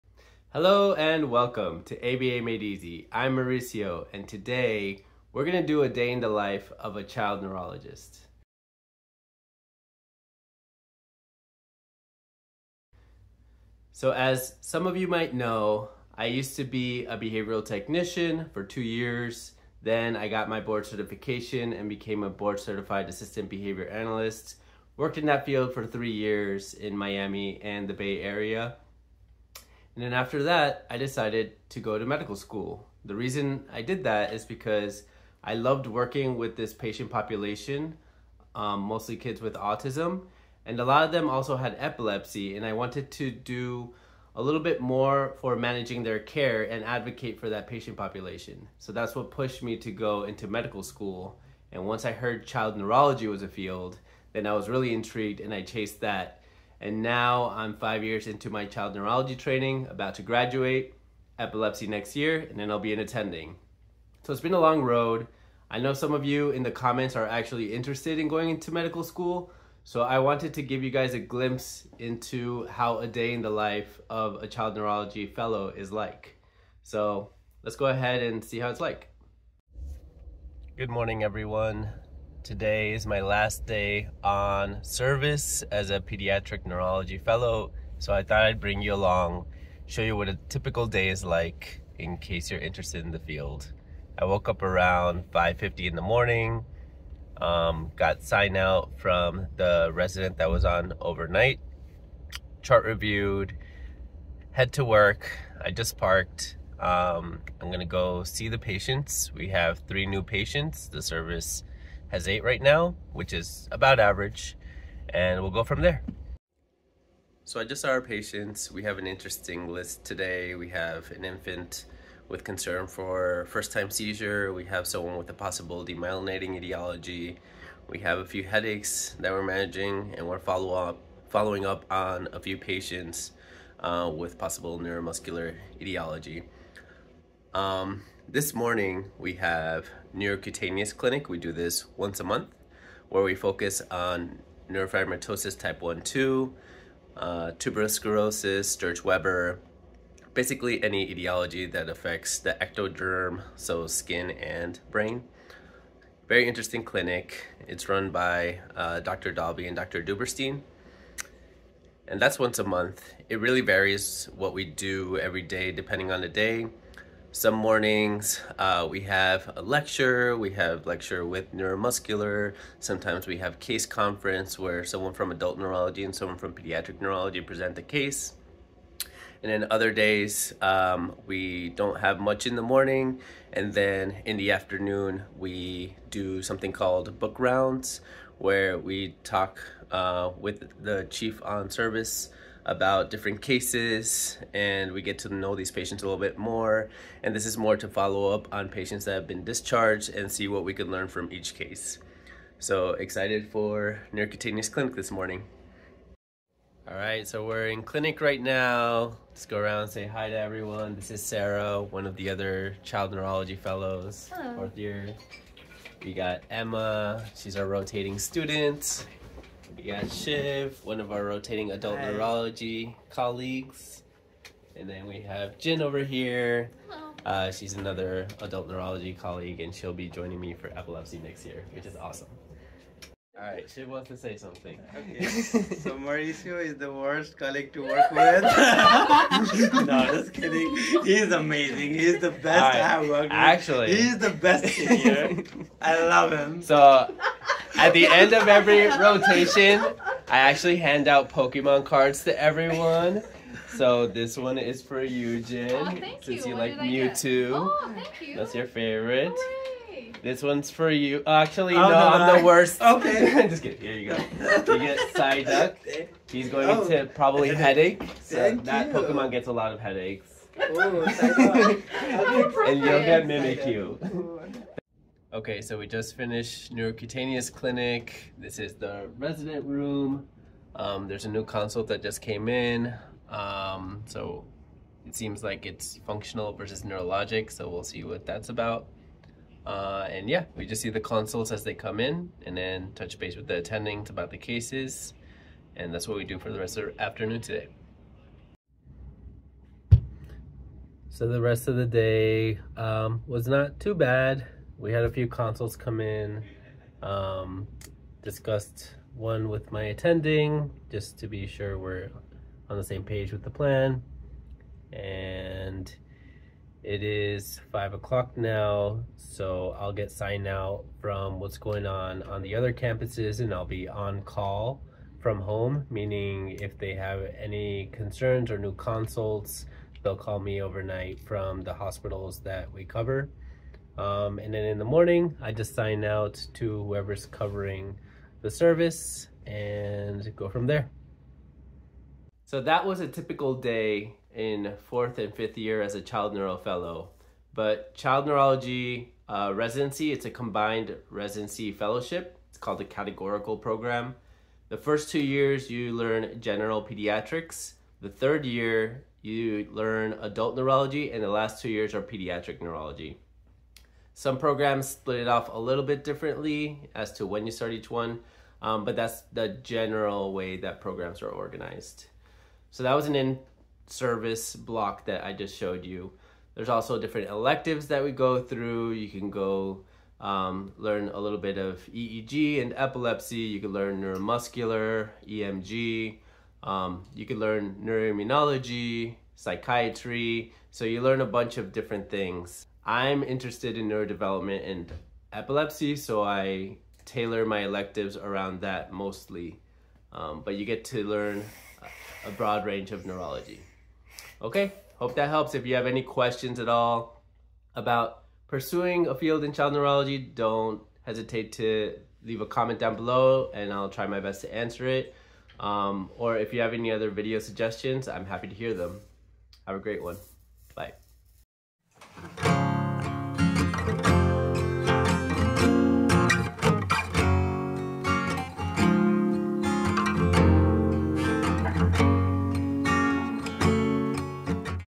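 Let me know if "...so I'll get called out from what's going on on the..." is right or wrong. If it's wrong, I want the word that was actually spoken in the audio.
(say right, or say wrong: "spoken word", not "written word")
wrong: "signed", not "called".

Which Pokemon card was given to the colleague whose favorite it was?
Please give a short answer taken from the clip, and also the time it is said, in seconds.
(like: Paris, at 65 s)
Mewtwo, at 256 s.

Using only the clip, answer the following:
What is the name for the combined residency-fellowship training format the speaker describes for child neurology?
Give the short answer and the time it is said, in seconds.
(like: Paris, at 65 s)
categorical program, at 352 s.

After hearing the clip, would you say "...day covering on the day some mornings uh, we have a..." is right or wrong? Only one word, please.
wrong.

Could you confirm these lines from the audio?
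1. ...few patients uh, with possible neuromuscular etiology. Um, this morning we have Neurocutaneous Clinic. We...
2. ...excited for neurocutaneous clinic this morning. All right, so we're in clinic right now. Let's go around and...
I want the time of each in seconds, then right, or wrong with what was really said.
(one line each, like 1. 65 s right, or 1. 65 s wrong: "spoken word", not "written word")
1. 132 s right
2. 202 s right.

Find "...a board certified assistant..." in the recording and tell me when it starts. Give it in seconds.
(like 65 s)
22 s.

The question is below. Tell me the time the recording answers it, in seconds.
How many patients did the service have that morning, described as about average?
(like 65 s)
112 s.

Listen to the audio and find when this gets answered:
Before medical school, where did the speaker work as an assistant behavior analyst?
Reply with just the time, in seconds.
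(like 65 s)
26 s.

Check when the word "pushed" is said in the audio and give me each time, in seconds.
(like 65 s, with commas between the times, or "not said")
49 s.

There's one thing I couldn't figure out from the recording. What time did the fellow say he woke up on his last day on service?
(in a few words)
5:50.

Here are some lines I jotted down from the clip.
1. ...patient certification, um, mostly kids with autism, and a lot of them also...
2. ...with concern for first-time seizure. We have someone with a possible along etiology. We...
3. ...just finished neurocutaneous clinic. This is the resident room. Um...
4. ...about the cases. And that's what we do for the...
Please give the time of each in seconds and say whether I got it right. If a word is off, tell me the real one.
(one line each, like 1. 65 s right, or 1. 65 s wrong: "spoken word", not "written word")
1. 36 s wrong: "population", not "certification"
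2. 122 s wrong: "demyelinating", not "along"
3. 275 s right
4. 294 s right.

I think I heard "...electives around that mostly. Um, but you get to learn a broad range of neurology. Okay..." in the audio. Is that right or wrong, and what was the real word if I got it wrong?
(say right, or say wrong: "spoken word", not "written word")
right.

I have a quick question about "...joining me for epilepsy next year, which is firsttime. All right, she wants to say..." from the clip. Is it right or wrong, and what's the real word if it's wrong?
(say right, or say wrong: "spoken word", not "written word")
wrong: "awesome", not "firsttime".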